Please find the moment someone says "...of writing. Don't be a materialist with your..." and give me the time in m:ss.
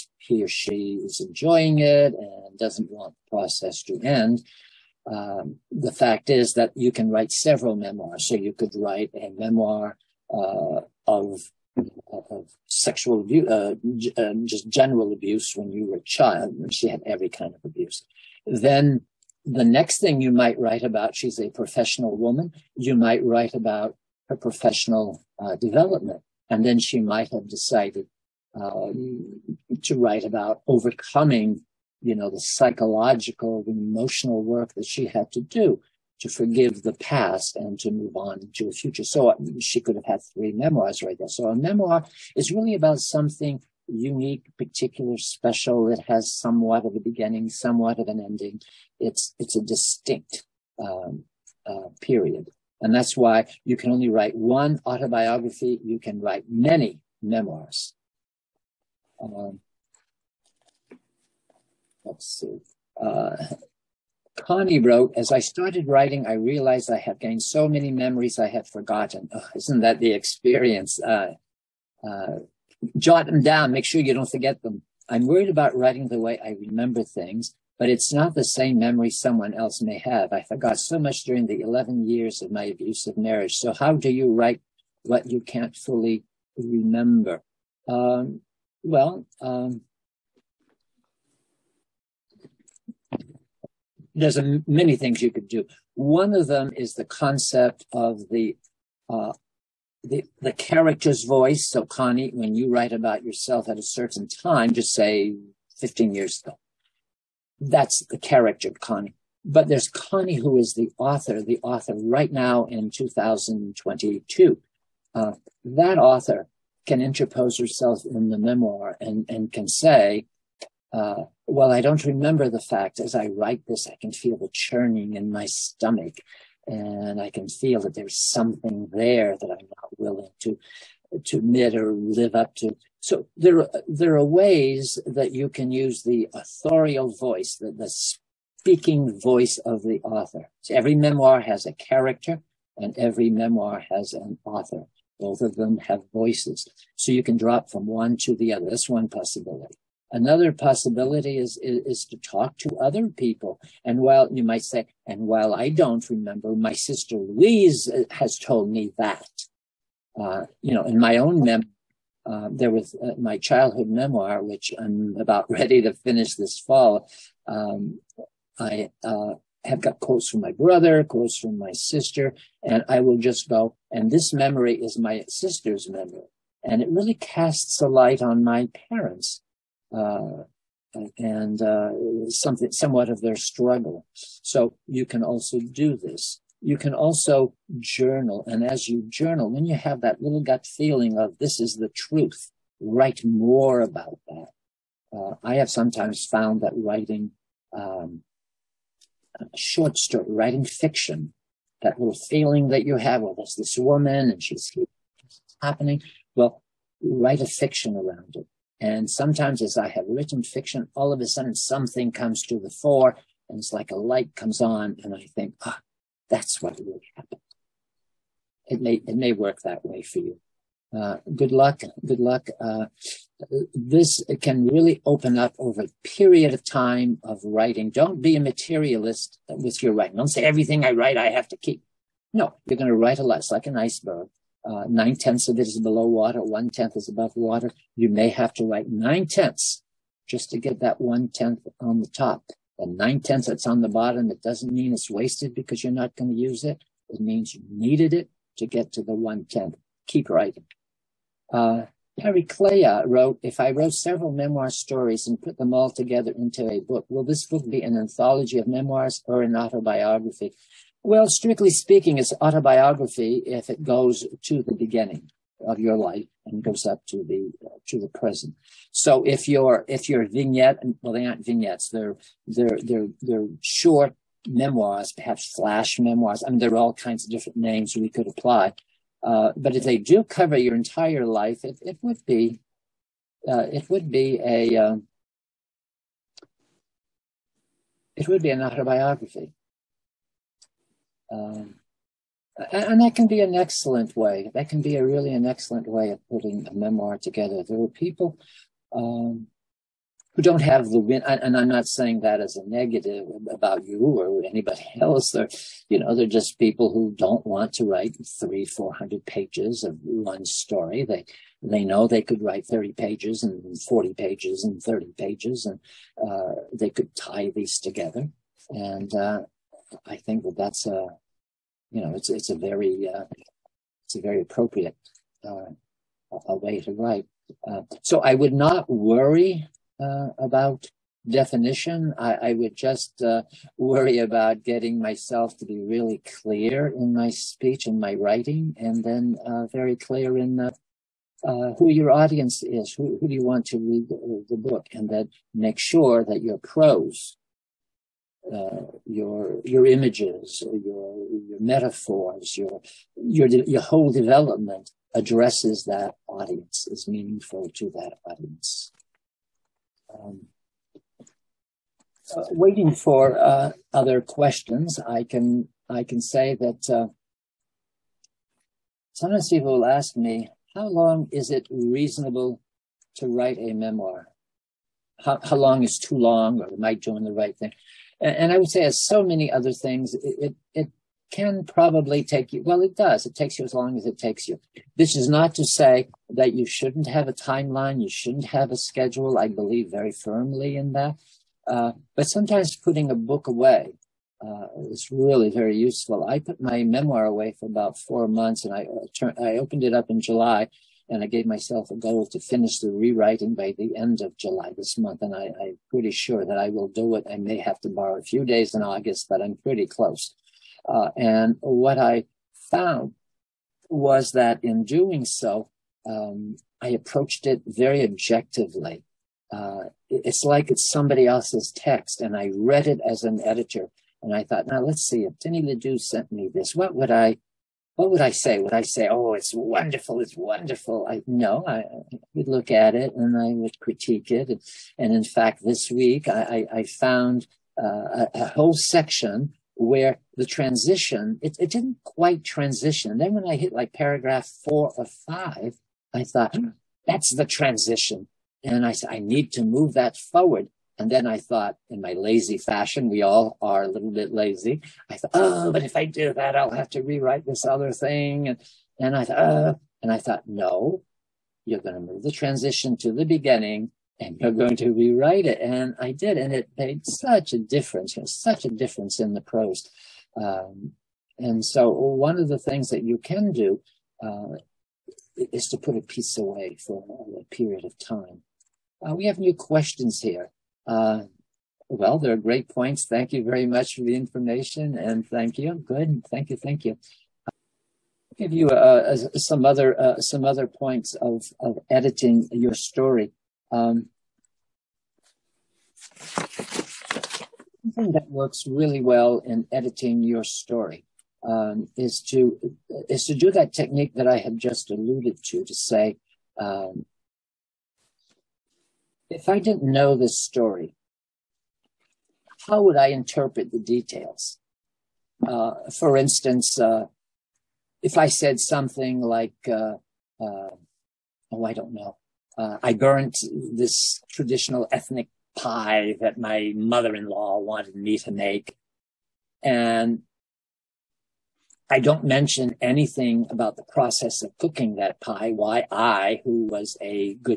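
3:47.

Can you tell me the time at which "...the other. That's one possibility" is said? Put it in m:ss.
2:28.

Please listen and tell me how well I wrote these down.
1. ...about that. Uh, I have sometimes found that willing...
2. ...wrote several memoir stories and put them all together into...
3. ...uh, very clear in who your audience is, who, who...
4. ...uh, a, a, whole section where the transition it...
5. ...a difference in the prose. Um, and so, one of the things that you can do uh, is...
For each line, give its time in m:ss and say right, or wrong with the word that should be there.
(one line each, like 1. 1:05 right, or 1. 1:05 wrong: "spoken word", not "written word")
1. 3:13 wrong: "writing", not "willing"
2. 4:13 right
3. 5:39 right
4. 7:17 right
5. 7:48 right.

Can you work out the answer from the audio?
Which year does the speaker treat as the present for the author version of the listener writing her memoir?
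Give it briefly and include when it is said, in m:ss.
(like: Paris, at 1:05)
2022, at 1:52.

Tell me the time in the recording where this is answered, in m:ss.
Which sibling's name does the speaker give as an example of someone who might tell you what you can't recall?
2:37.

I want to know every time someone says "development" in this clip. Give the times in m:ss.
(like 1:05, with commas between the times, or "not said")
0:25, 5:54.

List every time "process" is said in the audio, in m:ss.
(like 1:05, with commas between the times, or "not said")
0:03, 8:53.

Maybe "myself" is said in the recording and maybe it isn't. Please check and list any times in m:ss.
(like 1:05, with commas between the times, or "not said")
5:35, 6:41.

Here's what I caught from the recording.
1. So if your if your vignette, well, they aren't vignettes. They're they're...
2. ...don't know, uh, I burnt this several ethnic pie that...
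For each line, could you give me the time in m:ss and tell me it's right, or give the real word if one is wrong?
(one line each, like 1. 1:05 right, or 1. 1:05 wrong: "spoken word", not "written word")
1. 4:28 right
2. 8:41 wrong: "traditional", not "several".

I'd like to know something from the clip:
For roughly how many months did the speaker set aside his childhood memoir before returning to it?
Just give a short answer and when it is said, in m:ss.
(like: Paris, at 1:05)
4 months, at 6:38.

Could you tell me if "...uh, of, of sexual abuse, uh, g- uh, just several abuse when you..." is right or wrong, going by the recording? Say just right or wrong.
wrong.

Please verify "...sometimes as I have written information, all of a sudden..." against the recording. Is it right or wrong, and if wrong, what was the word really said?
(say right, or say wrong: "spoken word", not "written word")
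wrong: "fiction", not "information".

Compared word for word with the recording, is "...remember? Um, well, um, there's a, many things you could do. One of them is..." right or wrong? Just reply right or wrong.
right.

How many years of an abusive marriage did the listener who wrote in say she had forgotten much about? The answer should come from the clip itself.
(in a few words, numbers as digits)
11.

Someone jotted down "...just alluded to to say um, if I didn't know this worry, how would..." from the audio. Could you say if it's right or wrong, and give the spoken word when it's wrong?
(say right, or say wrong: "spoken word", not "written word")
wrong: "story", not "worry".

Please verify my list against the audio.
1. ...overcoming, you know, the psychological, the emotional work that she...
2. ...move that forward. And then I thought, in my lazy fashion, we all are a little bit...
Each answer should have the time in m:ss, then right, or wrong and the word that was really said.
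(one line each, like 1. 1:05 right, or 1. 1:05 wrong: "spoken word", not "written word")
1. 0:30 right
2. 7:29 right.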